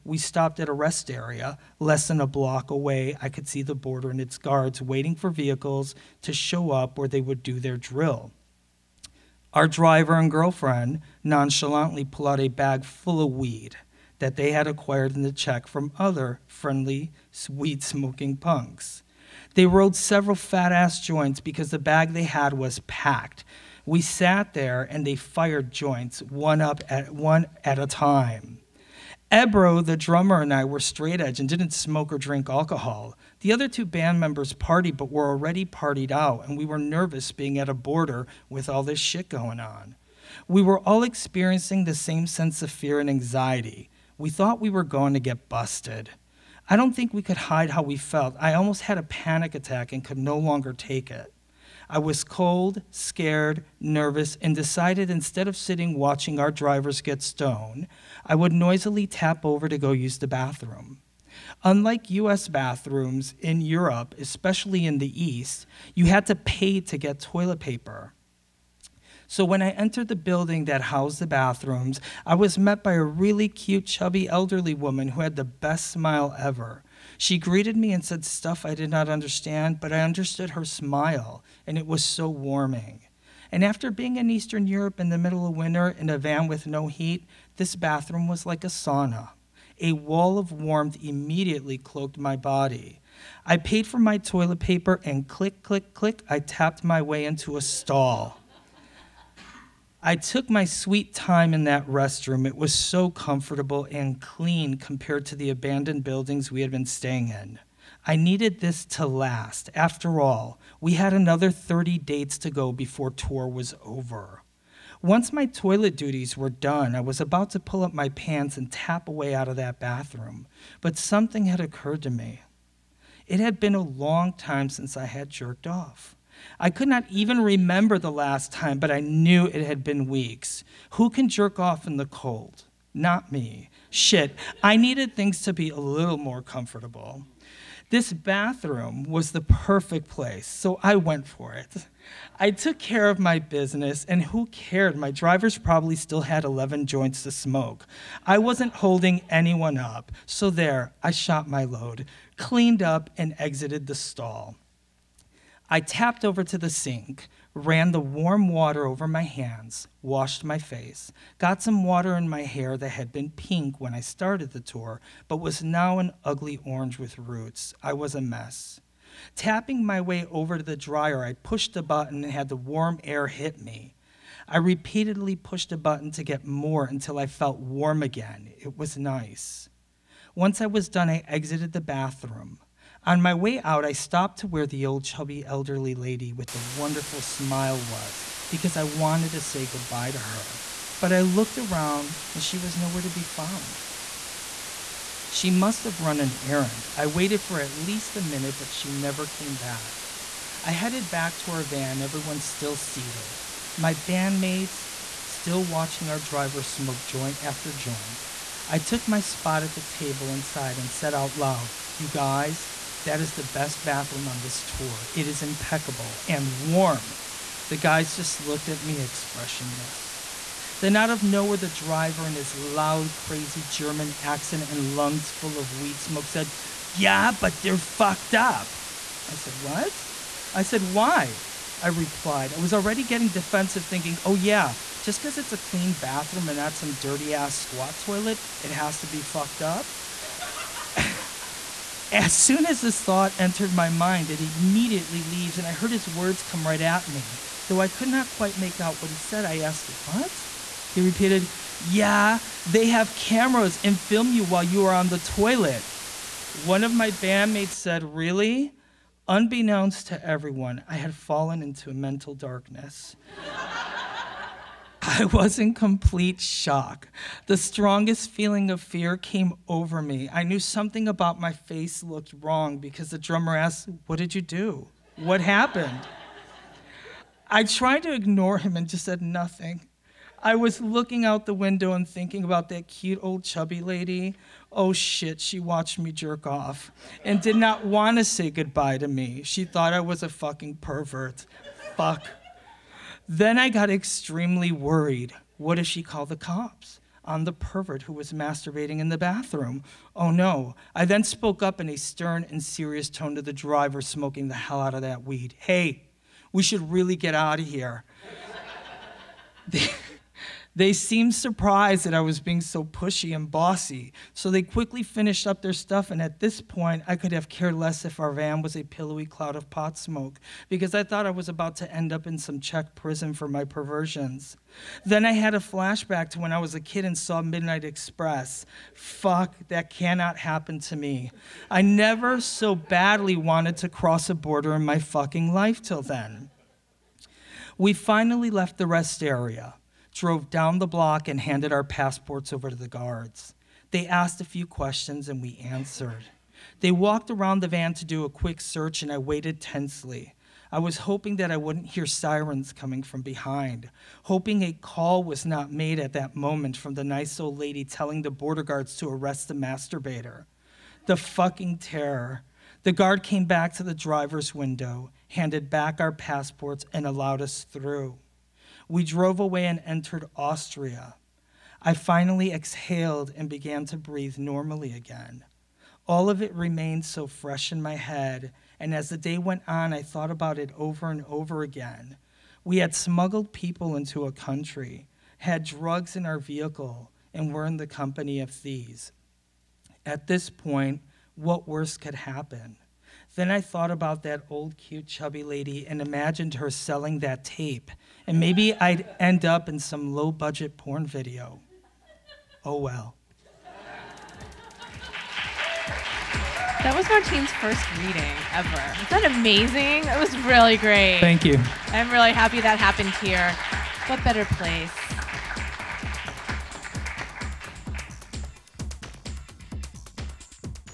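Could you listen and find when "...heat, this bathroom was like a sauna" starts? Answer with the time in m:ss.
1:26.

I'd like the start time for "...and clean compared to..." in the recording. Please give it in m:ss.
1:43.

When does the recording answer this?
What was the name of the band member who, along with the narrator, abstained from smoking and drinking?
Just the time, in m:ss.
0:29.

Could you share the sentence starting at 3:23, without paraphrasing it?
My bandmates still watching our driver smoke joint after joint.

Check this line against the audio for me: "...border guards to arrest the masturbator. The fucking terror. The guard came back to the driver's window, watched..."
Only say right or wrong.
wrong.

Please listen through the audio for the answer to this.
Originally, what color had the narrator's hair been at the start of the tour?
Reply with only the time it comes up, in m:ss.
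2:43.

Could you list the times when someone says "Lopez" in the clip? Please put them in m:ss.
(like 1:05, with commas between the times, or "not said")
not said.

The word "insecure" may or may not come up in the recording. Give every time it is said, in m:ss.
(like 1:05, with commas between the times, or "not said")
not said.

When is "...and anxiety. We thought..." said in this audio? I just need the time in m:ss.
0:42.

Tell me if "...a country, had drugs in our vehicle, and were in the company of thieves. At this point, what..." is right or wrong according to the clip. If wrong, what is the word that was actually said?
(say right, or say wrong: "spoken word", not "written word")
right.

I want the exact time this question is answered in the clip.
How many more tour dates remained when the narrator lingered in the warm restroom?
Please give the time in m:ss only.
1:51.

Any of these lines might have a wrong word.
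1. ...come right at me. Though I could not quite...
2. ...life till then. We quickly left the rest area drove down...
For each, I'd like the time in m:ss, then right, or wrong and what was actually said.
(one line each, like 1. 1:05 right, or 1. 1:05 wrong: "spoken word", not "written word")
1. 4:06 right
2. 5:35 wrong: "finally", not "quickly".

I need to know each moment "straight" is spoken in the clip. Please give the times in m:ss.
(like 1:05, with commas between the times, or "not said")
0:30.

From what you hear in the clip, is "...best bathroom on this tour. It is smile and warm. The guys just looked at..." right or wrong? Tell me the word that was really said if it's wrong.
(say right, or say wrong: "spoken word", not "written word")
wrong: "impeccable", not "smile".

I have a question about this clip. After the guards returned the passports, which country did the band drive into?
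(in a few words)
Austria.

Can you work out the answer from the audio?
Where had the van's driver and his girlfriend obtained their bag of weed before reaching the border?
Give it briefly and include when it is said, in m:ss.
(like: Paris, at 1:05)
the Czech, at 0:15.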